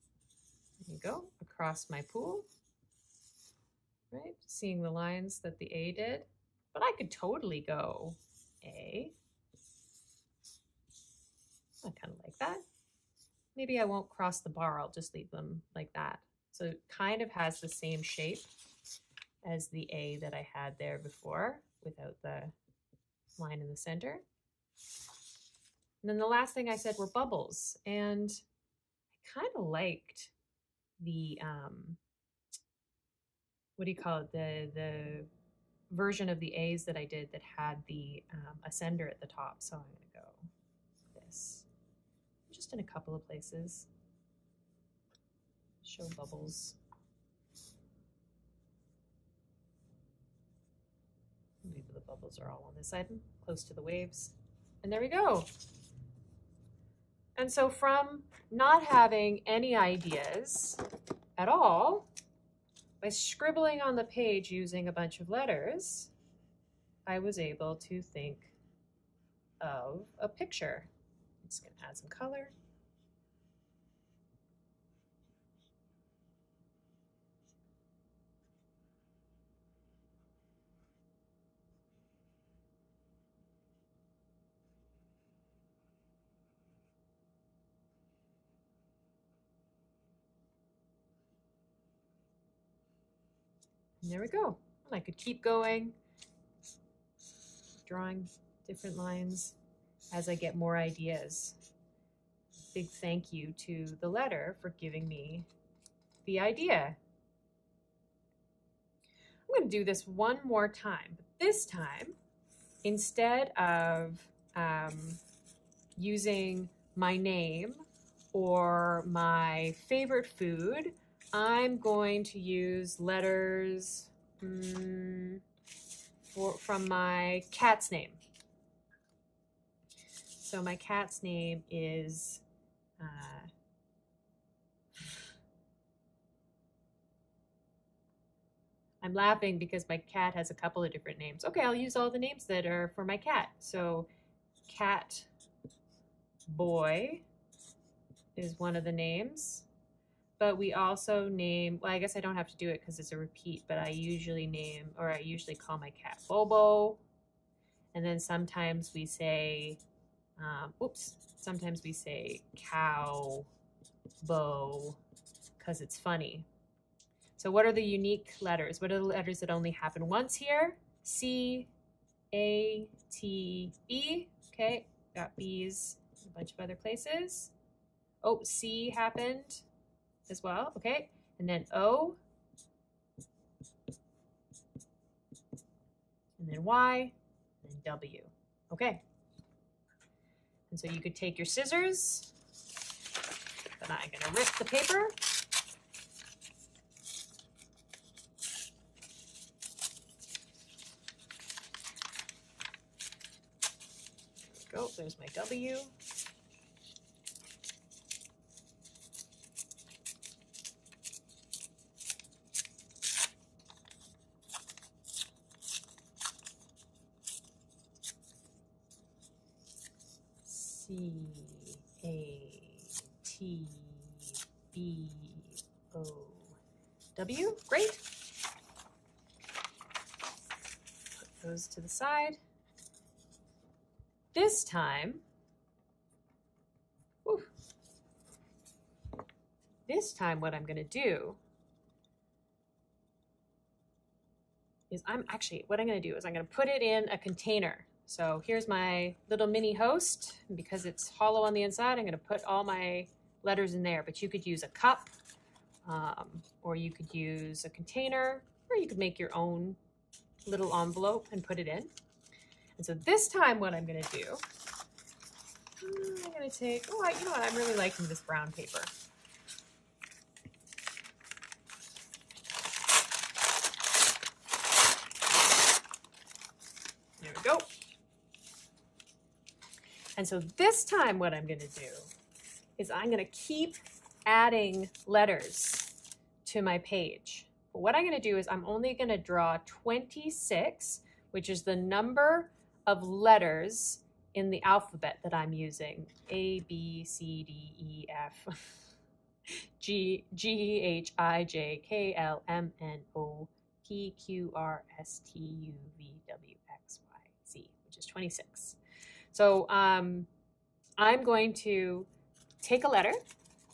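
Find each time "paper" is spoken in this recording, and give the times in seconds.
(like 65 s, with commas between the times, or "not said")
194 s, 268 s.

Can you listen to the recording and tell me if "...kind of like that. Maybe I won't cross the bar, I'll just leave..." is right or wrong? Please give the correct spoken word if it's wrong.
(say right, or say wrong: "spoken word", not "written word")
right.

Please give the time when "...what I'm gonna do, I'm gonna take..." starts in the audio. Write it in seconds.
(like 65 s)
263 s.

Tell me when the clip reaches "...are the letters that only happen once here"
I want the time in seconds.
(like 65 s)
168 s.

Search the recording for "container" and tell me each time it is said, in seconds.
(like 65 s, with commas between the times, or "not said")
247 s, 257 s.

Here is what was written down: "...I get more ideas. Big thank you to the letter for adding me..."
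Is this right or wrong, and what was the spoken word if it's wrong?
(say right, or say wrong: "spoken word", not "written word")
wrong: "giving", not "adding".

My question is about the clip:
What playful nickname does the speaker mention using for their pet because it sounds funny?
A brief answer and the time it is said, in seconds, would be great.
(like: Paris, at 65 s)
Cow bow, at 162 s.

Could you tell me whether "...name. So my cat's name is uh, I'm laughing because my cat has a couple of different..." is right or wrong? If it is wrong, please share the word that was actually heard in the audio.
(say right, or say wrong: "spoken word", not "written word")
right.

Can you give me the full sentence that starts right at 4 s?
Right, seeing the lines that the A did.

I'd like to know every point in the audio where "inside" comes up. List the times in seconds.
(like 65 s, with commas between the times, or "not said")
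251 s.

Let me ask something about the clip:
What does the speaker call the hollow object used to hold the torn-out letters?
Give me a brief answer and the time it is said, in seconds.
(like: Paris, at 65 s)
mini host, at 249 s.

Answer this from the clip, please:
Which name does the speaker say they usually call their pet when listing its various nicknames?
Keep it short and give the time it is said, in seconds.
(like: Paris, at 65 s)
Bobo, at 156 s.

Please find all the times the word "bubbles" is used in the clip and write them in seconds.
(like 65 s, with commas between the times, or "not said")
27 s, 46 s, 52 s.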